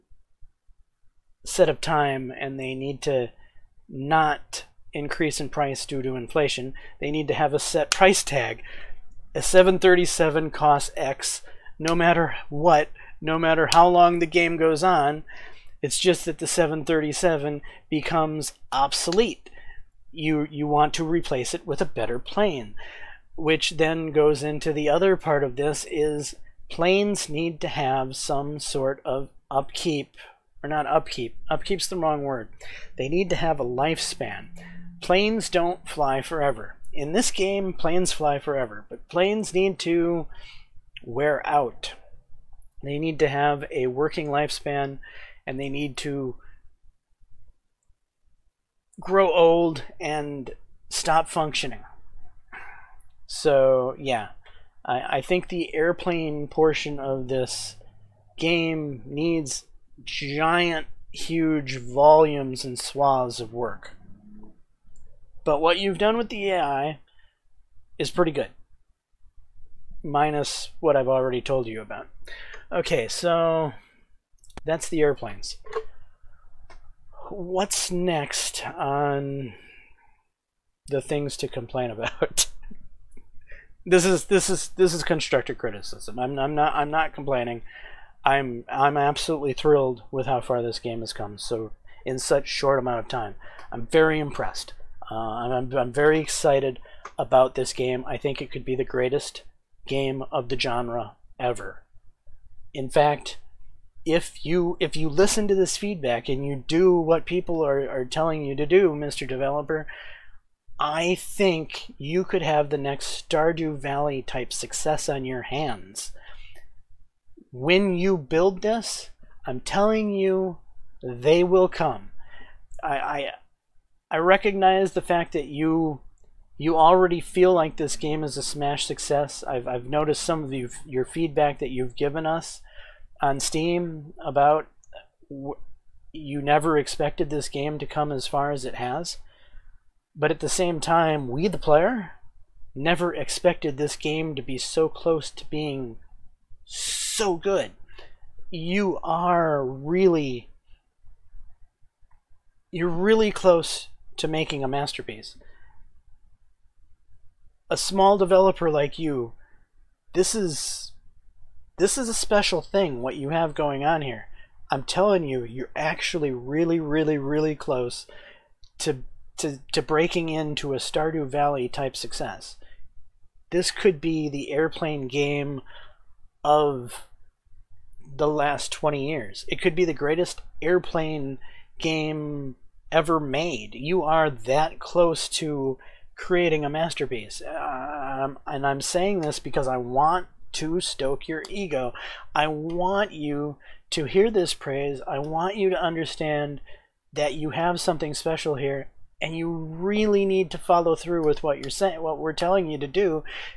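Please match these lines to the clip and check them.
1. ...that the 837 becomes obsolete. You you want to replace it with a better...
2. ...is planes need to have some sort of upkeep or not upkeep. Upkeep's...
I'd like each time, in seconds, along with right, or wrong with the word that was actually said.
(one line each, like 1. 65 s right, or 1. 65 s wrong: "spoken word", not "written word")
1. 16 s wrong: "737", not "837"
2. 25 s right.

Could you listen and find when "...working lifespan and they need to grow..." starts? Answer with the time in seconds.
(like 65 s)
43 s.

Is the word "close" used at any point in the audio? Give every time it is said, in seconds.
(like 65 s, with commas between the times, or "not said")
144 s, 153 s, 167 s, 184 s.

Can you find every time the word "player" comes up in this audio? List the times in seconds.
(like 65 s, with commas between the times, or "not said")
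141 s.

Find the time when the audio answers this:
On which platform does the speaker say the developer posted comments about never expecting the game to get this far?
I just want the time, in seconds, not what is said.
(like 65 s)
133 s.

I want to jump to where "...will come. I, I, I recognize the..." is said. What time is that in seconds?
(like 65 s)
121 s.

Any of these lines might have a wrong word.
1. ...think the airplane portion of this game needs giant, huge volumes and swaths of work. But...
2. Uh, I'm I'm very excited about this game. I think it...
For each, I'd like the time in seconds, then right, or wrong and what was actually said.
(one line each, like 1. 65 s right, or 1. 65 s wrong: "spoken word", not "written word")
1. 55 s right
2. 95 s right.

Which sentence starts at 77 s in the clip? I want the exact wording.
What's next on the things to complain about?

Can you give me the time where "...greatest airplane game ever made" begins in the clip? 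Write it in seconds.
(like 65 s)
179 s.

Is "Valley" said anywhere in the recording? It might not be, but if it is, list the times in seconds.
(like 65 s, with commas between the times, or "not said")
113 s, 171 s.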